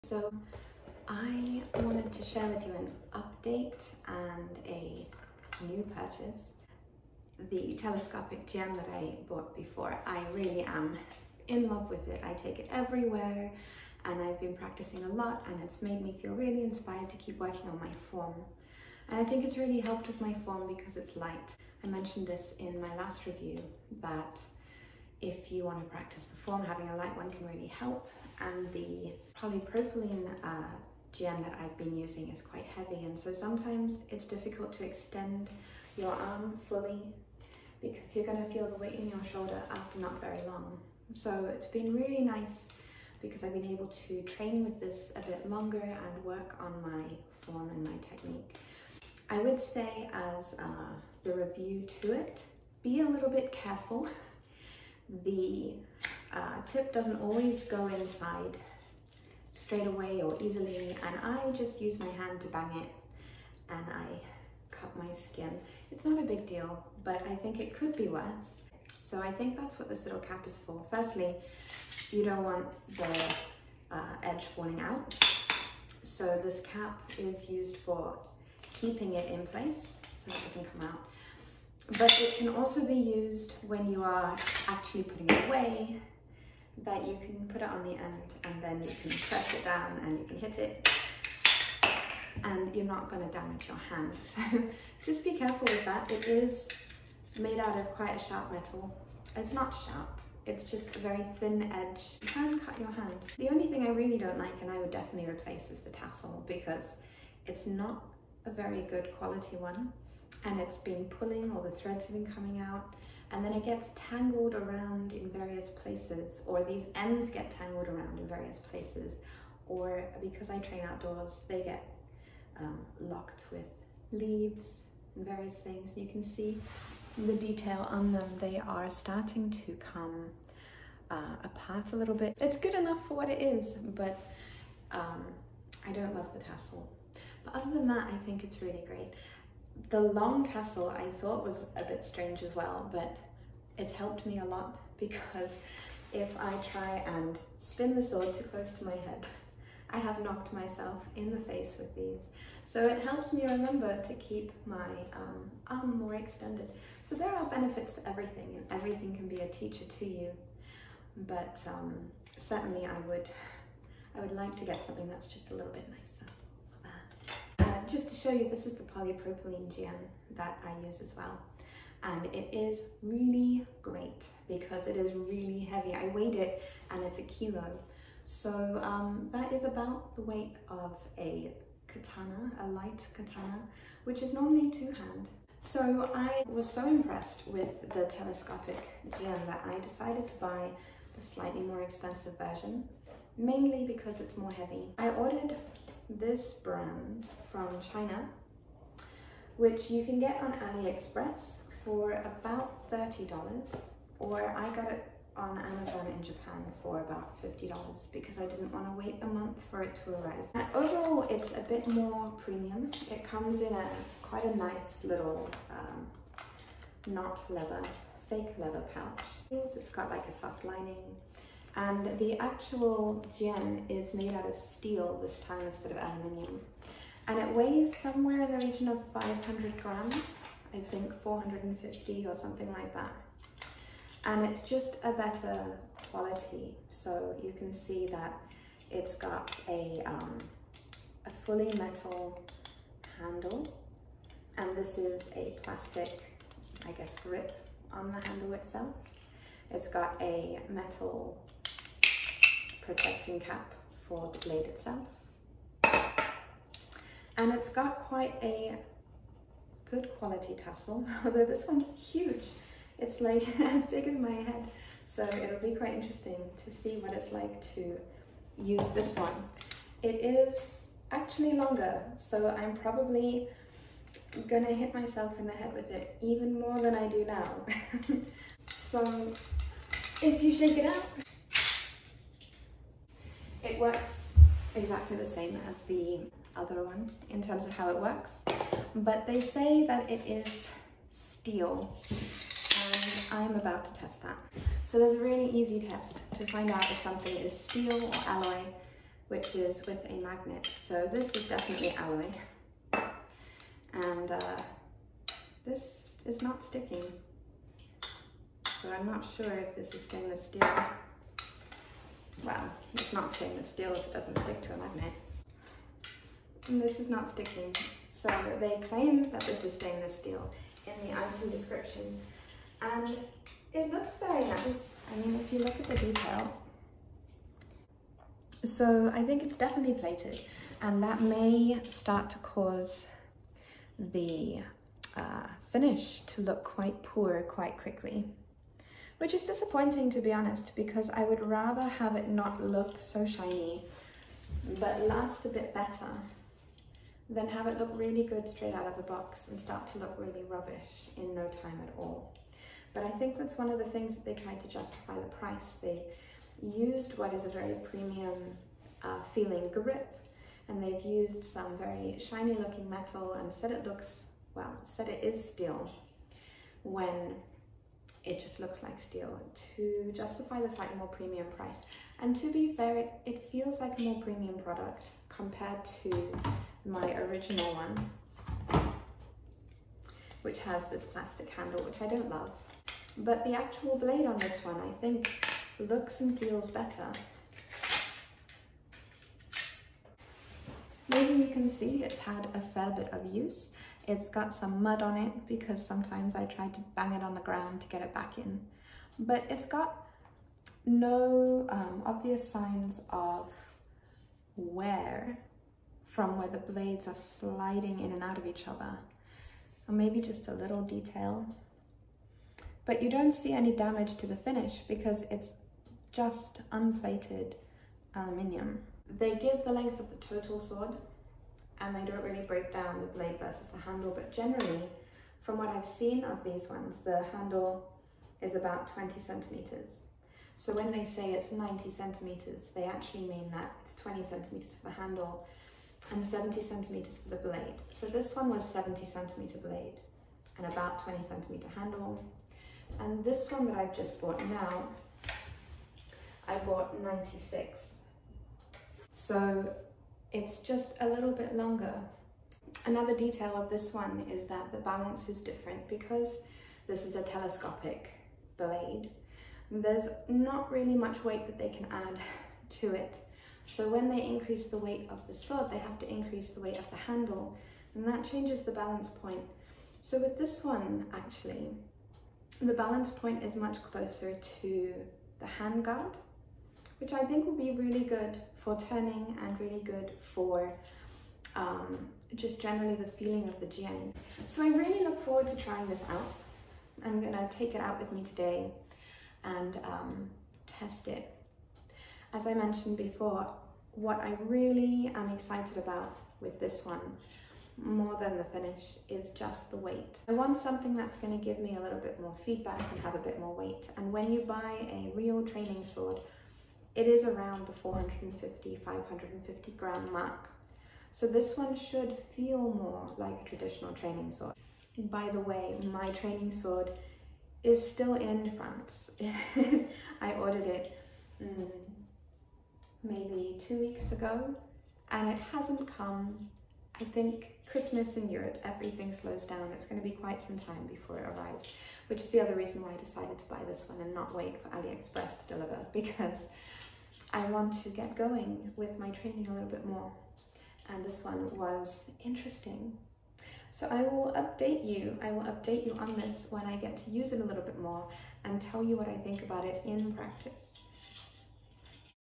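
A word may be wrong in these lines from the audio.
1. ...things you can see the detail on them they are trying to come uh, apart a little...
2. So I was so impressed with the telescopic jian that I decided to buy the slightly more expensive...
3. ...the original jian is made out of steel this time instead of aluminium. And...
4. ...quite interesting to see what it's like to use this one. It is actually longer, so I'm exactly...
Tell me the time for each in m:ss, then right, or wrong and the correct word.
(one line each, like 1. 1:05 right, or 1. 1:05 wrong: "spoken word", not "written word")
1. 2:05 wrong: "starting", not "trying"
2. 3:05 right
3. 3:42 wrong: "actual", not "original"
4. 4:25 wrong: "probably", not "exactly".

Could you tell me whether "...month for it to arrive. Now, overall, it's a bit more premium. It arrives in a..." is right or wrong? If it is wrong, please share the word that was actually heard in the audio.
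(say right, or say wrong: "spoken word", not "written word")
wrong: "comes", not "arrives".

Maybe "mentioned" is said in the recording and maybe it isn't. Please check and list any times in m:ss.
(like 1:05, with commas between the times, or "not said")
0:21, 8:12.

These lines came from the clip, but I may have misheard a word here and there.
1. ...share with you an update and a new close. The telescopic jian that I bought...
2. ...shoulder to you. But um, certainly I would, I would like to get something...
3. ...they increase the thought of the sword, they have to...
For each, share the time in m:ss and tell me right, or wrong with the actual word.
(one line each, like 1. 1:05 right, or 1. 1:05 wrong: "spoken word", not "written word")
1. 0:02 wrong: "purchase", not "close"
2. 2:39 wrong: "teacher", not "shoulder"
3. 7:44 wrong: "weight", not "thought".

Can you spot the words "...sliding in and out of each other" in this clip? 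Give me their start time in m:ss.
6:47.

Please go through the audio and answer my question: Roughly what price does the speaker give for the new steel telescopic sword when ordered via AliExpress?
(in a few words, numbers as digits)
$30.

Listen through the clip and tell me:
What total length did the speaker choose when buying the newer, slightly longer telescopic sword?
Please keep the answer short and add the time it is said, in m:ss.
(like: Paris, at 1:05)
96, at 7:27.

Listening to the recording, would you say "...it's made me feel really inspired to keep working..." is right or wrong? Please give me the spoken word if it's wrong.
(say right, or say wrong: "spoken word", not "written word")
right.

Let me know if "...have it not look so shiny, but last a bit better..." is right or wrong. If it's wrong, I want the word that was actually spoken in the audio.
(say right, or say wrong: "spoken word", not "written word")
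right.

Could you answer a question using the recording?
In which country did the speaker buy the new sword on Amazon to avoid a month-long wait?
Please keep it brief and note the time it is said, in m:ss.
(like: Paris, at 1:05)
Japan, at 3:26.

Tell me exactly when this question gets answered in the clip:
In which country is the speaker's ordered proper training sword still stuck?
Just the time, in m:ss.
8:38.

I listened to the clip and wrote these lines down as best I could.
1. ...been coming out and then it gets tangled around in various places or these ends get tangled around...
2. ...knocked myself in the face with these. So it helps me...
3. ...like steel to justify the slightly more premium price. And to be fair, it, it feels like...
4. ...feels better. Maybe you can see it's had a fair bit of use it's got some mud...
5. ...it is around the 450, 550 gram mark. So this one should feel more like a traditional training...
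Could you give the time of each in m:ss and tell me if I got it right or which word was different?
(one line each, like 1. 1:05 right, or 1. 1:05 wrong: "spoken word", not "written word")
1. 1:52 right
2. 2:30 right
3. 6:08 right
4. 6:26 right
5. 8:26 right.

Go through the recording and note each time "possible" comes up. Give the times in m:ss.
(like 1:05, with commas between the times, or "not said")
not said.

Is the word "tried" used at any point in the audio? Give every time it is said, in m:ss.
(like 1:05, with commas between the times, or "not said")
5:54, 6:36.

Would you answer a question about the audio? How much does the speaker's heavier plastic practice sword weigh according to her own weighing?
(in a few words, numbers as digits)
1 kilo.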